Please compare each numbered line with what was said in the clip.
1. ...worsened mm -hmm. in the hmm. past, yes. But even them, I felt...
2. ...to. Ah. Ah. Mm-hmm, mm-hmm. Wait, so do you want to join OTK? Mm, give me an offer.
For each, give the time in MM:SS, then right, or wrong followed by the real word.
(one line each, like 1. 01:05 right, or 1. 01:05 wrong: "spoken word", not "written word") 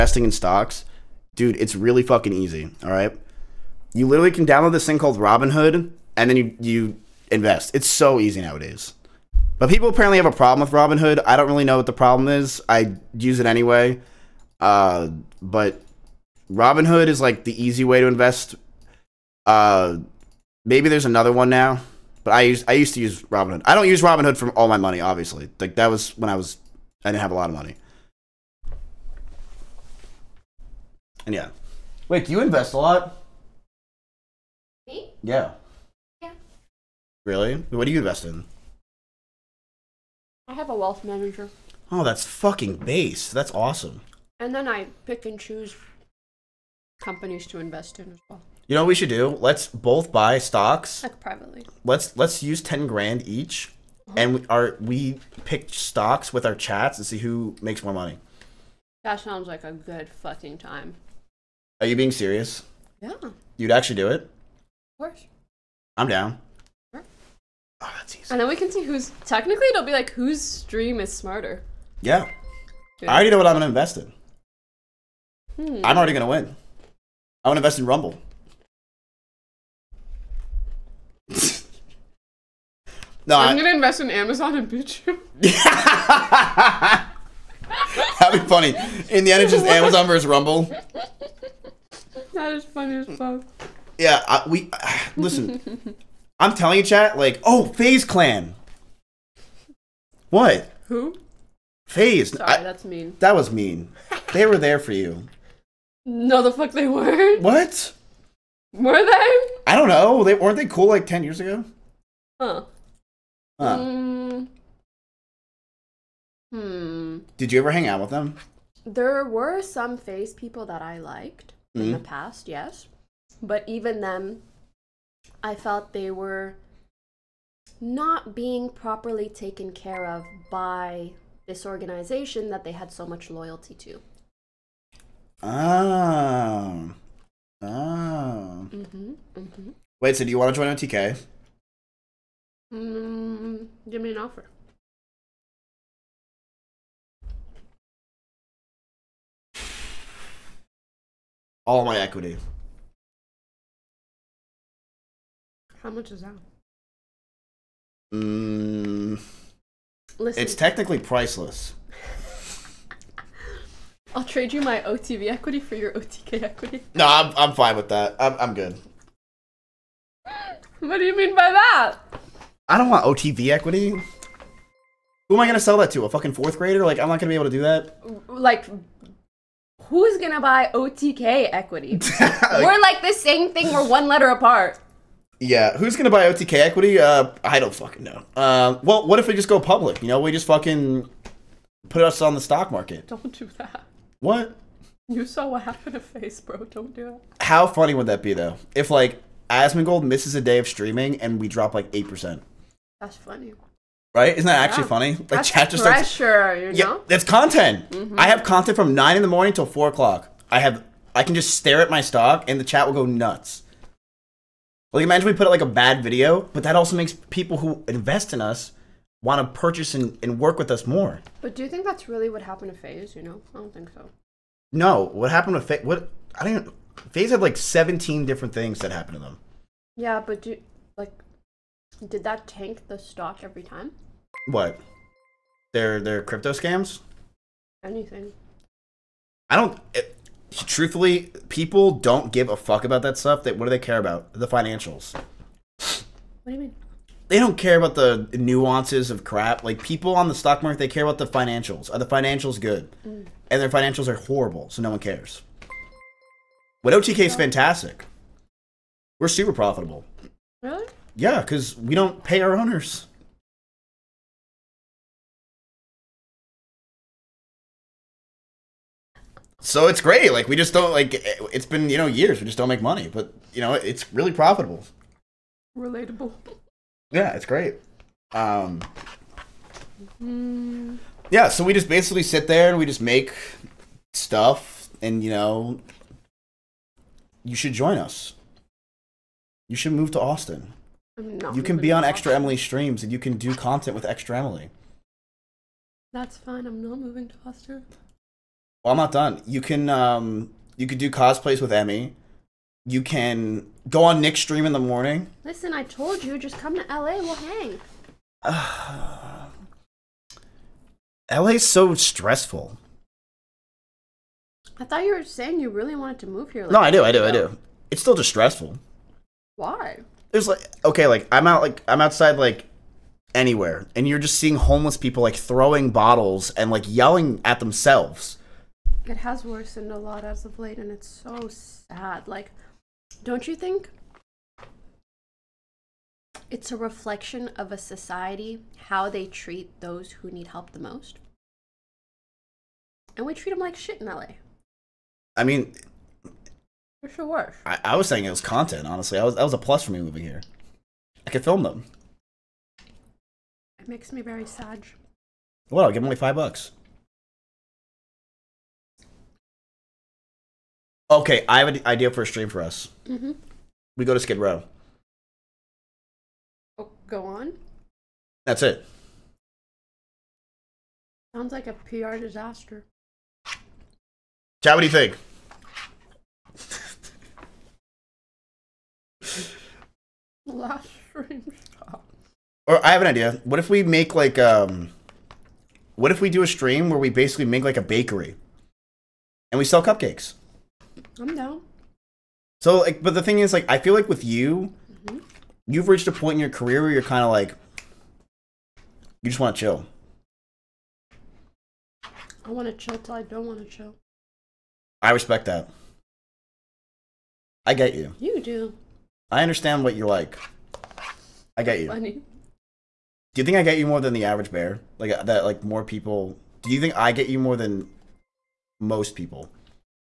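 1. 02:00 wrong: "liked", not "worsened"
2. 02:13 right.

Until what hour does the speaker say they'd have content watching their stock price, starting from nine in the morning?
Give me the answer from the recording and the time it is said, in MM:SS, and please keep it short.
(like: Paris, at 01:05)
4 o'clock, at 03:29.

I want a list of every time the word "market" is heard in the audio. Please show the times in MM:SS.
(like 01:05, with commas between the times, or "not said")
03:12, 04:10.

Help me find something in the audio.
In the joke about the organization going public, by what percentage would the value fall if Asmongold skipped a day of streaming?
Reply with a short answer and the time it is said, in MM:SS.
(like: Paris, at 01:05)
8%, at 03:21.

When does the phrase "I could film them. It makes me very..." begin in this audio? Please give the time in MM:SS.
05:51.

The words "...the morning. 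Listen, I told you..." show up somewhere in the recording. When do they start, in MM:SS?
05:04.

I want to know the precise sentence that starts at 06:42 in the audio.
I want to chill till I don't want to chill.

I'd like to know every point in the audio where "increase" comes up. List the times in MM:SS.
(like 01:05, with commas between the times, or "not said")
not said.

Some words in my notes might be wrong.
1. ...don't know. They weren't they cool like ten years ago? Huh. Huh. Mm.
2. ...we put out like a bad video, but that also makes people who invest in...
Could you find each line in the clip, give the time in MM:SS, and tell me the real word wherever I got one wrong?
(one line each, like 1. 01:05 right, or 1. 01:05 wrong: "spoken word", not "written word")
1. 01:49 right
2. 03:35 right.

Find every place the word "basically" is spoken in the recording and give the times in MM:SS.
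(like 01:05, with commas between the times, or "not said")
04:41, 06:27.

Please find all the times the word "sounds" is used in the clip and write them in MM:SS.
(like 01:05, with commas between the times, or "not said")
00:59, 06:11.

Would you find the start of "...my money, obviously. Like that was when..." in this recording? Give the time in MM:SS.
00:24.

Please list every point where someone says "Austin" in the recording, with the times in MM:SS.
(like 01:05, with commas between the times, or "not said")
04:50, 04:57.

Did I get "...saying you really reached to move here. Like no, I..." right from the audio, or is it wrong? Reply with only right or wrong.
wrong.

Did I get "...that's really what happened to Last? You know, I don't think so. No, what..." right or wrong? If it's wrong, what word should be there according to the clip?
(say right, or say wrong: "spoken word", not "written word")
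wrong: "FaZe", not "Last".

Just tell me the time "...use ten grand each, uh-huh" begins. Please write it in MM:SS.
00:52.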